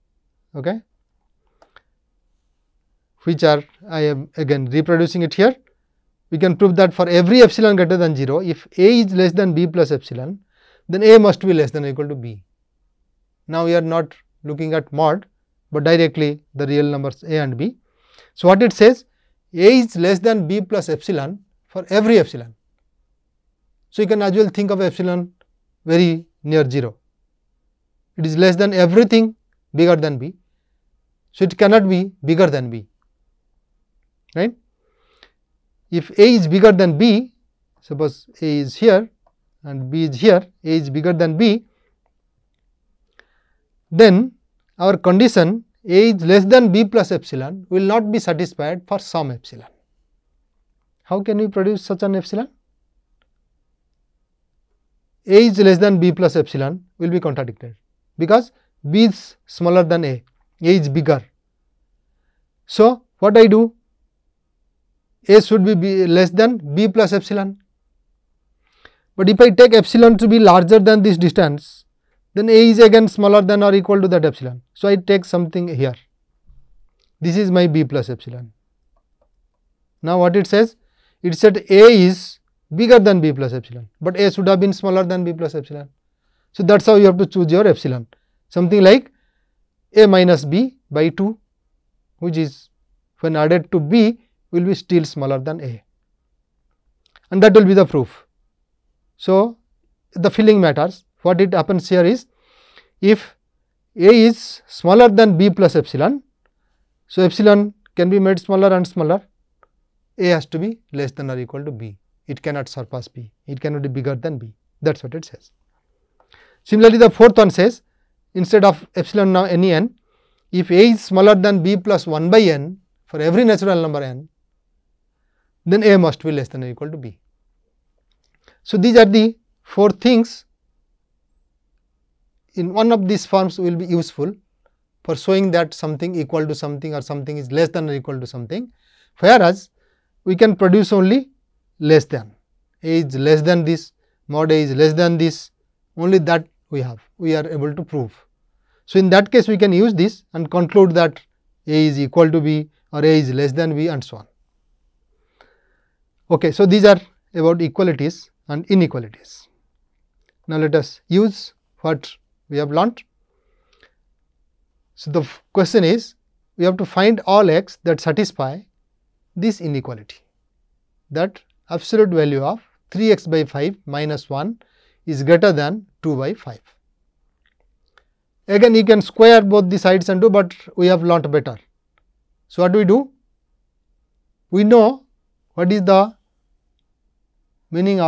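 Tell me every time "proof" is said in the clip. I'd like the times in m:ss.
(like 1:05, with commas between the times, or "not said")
1:37.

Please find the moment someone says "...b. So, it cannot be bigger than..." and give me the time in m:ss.
0:30.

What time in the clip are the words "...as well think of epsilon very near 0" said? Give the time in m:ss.
0:24.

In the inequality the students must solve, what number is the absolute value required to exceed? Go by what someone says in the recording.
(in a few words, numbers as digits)
2/5.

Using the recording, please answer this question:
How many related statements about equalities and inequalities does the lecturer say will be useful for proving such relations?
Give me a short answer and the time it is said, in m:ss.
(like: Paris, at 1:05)
4, at 2:09.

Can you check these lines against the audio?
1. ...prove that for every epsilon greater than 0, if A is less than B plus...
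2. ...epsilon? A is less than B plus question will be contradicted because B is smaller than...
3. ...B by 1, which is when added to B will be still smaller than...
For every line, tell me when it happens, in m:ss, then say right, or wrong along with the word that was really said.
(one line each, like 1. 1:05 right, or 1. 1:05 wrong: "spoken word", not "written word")
1. 0:06 right
2. 0:52 wrong: "epsilon", not "question"
3. 1:30 wrong: "2", not "1".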